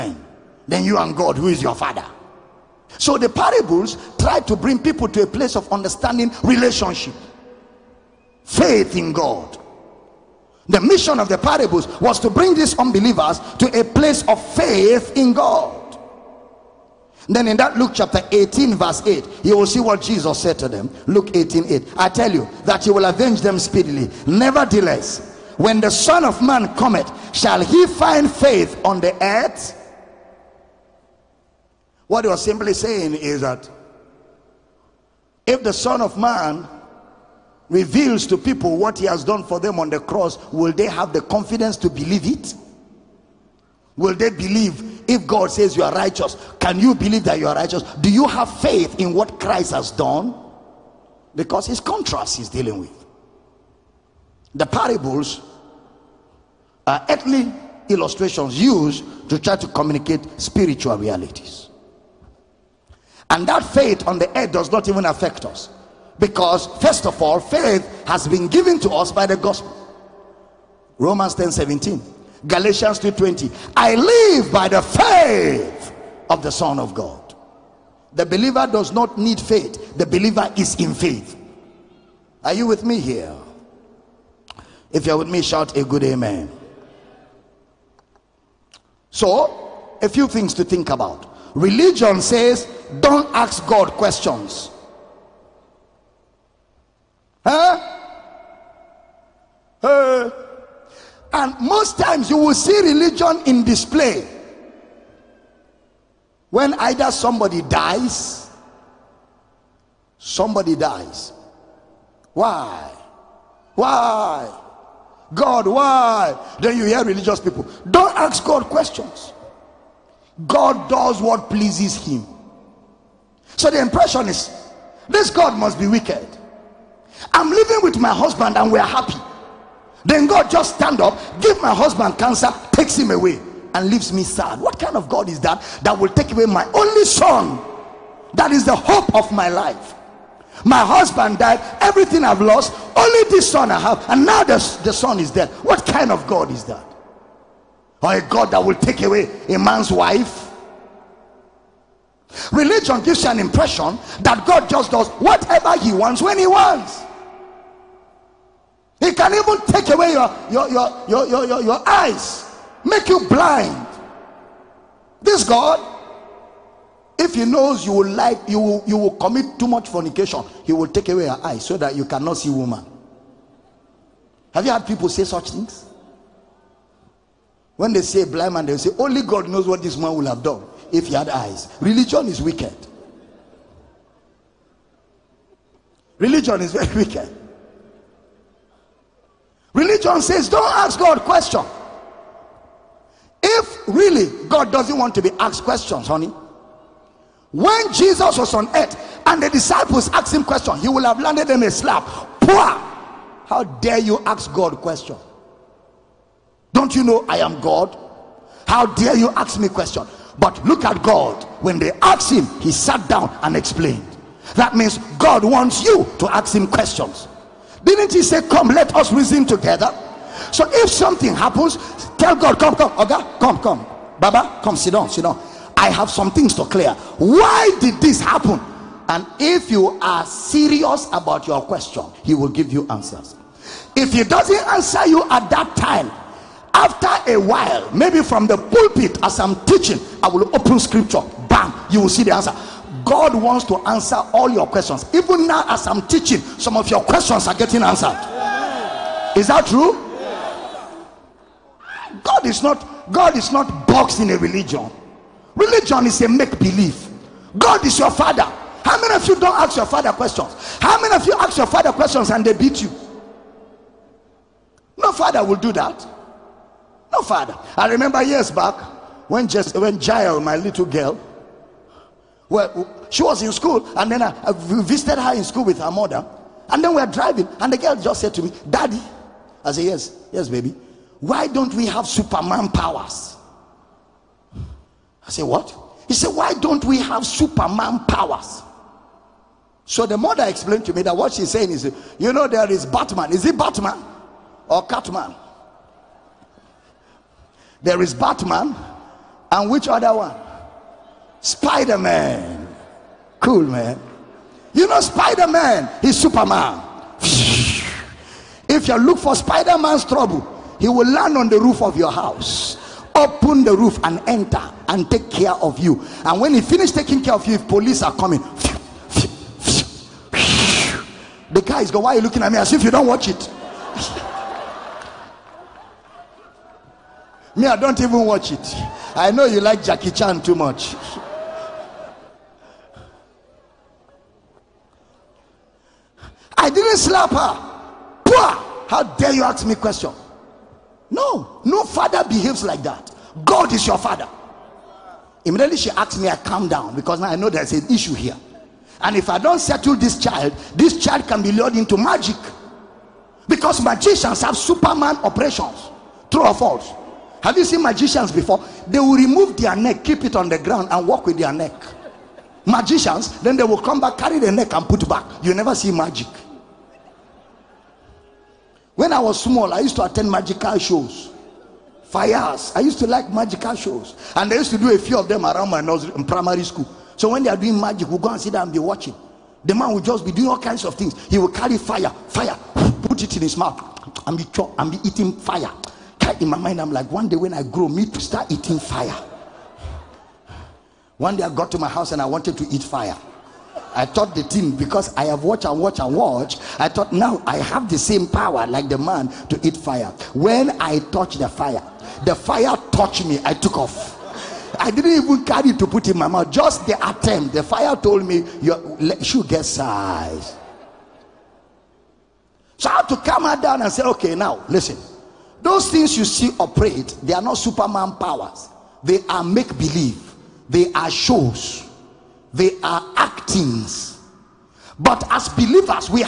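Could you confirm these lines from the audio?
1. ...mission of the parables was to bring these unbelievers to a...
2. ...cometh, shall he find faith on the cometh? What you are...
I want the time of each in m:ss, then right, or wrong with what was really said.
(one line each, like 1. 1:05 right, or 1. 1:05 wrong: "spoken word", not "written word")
1. 0:10 right
2. 0:26 wrong: "earth", not "cometh".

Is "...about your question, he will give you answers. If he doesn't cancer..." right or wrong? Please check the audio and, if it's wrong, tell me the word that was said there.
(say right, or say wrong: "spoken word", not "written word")
wrong: "answer", not "cancer".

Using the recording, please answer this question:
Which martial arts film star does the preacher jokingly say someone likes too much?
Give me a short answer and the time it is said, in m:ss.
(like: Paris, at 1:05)
Jackie Chan, at 5:29.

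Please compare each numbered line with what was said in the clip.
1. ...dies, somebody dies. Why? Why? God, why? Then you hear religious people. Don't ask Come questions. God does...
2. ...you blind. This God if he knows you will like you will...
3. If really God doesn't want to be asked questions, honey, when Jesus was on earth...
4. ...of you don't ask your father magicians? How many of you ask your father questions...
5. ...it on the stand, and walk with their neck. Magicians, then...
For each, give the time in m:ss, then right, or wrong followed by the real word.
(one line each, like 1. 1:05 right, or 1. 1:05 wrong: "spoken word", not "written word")
1. 1:47 wrong: "God", not "Come"
2. 2:43 right
3. 3:13 right
4. 4:19 wrong: "questions", not "magicians"
5. 6:00 wrong: "ground", not "stand".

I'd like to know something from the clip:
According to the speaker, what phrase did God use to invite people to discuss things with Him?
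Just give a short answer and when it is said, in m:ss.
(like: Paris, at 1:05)
Come, let us reason together, at 3:38.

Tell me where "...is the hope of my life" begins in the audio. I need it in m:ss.
2:18.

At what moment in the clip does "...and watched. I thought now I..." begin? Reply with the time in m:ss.
6:35.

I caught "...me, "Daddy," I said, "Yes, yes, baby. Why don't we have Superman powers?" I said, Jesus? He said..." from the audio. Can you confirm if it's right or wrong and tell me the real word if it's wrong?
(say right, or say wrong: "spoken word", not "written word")
wrong: "What", not "Jesus".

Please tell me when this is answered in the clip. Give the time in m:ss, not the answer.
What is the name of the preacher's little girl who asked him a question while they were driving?
4:30.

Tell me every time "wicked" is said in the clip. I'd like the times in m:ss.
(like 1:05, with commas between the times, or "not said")
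2:05, 3:02, 3:07.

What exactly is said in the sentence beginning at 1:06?
Because, first of all, faith has been given to us by the gospel.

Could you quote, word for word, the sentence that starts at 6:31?
One day I got to my house and I wanted to eat fire.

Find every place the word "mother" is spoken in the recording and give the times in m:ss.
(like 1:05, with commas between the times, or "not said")
4:35, 4:50.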